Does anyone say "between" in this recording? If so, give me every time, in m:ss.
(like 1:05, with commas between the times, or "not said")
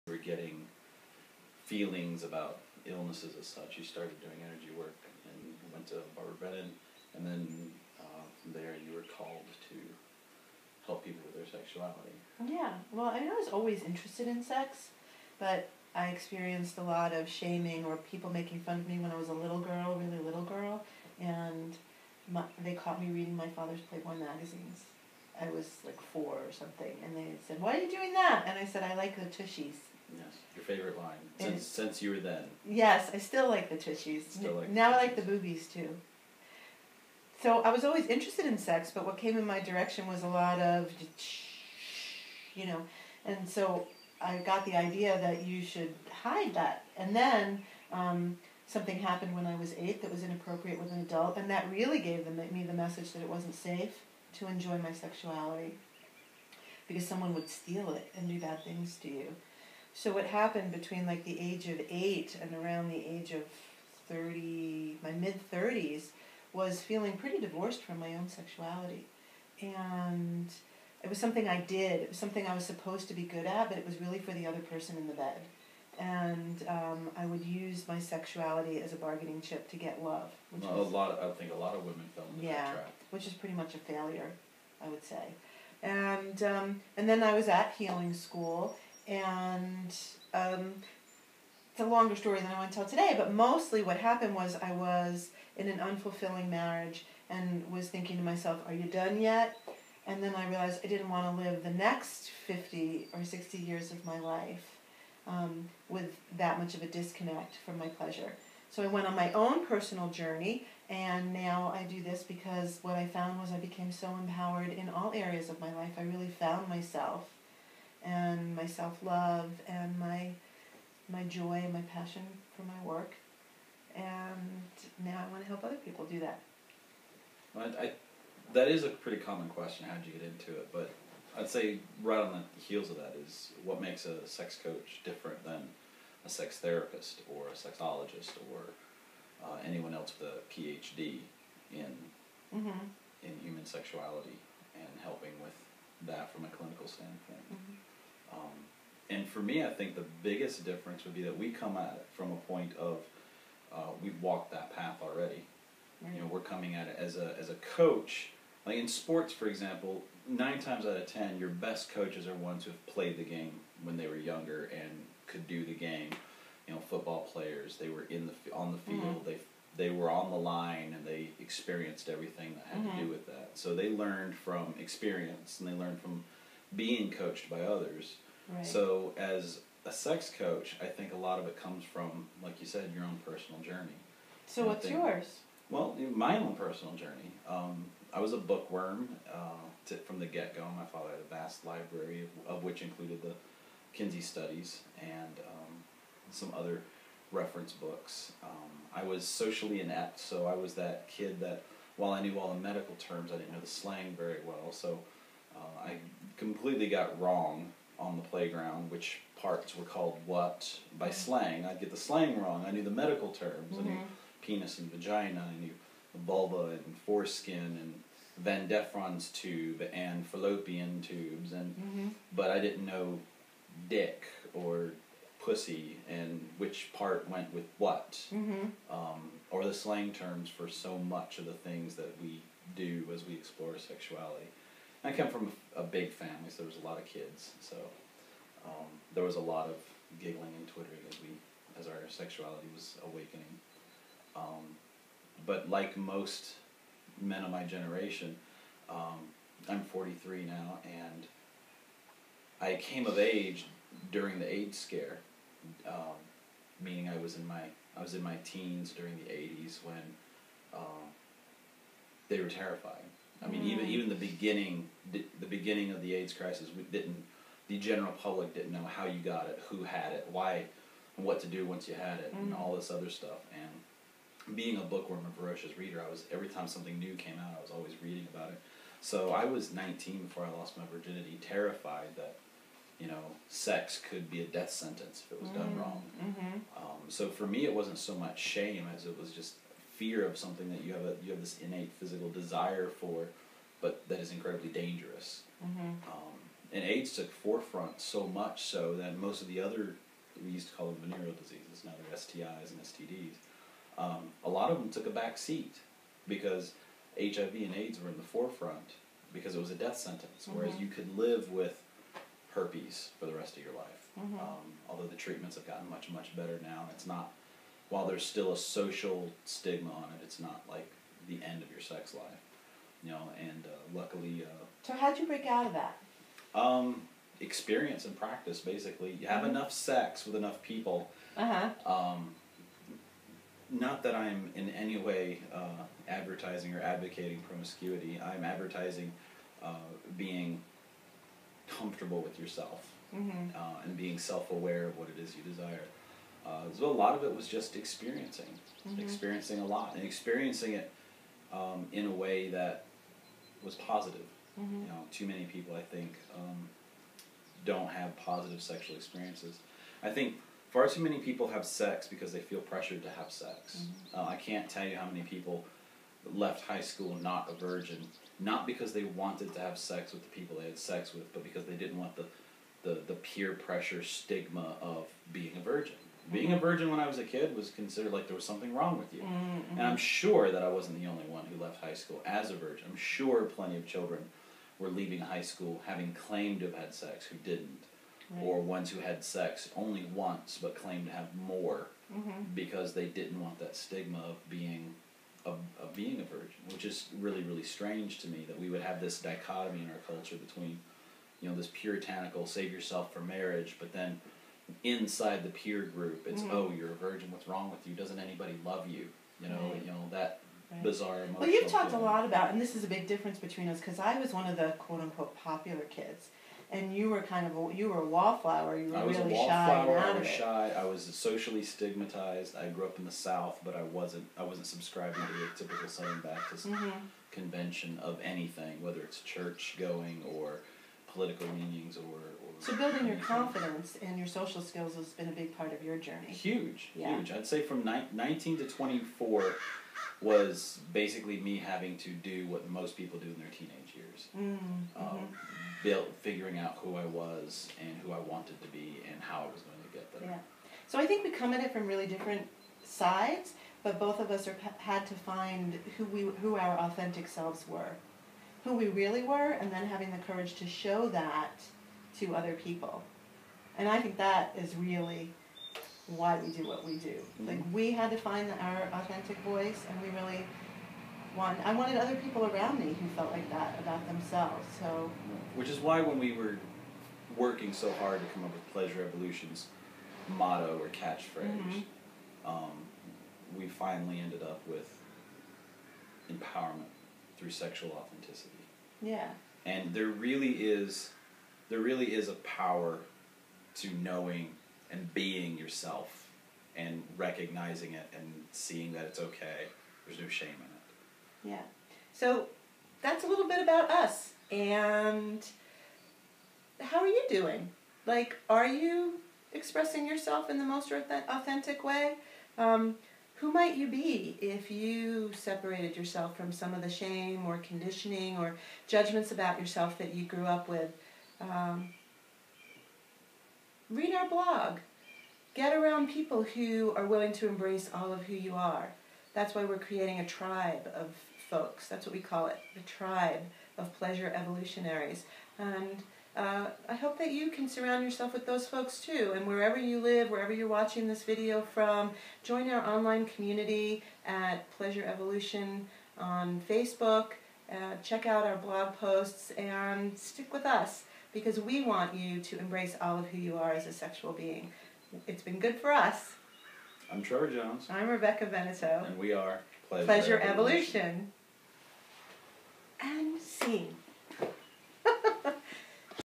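1:00, 6:40, 6:53.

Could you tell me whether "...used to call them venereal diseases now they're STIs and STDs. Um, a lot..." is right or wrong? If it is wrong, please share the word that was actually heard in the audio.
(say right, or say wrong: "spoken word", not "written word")
right.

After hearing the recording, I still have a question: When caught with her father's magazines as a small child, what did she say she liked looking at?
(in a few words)
The tushies.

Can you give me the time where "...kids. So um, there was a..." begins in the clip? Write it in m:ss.
3:57.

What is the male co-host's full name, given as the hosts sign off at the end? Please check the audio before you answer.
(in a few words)
Trevor Jones.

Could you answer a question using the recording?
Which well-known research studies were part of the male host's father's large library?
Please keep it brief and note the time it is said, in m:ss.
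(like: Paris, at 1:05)
The Kinsey Studies, at 3:13.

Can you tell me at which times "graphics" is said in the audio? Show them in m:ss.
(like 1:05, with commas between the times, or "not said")
not said.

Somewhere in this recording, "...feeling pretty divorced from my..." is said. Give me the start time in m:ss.
1:06.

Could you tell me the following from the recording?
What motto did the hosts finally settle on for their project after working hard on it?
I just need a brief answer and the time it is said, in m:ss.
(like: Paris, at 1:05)
Empowerment through sexual authenticity, at 8:06.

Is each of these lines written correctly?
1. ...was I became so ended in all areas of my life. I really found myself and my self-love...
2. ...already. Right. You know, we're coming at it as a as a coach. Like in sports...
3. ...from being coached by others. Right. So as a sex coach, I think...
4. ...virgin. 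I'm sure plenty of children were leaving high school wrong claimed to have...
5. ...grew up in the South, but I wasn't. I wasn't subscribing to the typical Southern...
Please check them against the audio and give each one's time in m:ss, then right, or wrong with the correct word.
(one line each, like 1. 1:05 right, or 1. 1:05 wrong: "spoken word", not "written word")
1. 1:53 wrong: "empowered", not "ended"
2. 2:35 right
3. 2:56 right
4. 6:22 wrong: "having", not "wrong"
5. 7:02 right.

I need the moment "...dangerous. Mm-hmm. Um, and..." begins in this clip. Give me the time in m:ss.
4:54.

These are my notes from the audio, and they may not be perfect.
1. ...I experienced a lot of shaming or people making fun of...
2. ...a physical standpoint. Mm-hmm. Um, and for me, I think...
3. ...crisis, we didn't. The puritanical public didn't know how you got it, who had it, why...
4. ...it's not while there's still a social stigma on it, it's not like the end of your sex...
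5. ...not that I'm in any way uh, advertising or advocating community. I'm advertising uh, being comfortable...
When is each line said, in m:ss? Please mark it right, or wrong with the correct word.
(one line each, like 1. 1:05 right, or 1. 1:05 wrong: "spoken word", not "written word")
1. 0:15 right
2. 2:26 wrong: "clinical", not "physical"
3. 4:26 wrong: "general", not "puritanical"
4. 5:16 right
5. 5:33 wrong: "promiscuity", not "community".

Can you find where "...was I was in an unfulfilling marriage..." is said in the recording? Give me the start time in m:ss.
1:34.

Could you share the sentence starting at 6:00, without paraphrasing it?
I think far too many people have sex because they feel pressured to have sex.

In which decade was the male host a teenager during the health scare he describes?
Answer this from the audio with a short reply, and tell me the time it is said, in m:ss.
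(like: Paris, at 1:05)
The 80s, at 4:19.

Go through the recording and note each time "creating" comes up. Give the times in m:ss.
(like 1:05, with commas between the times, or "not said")
8:49.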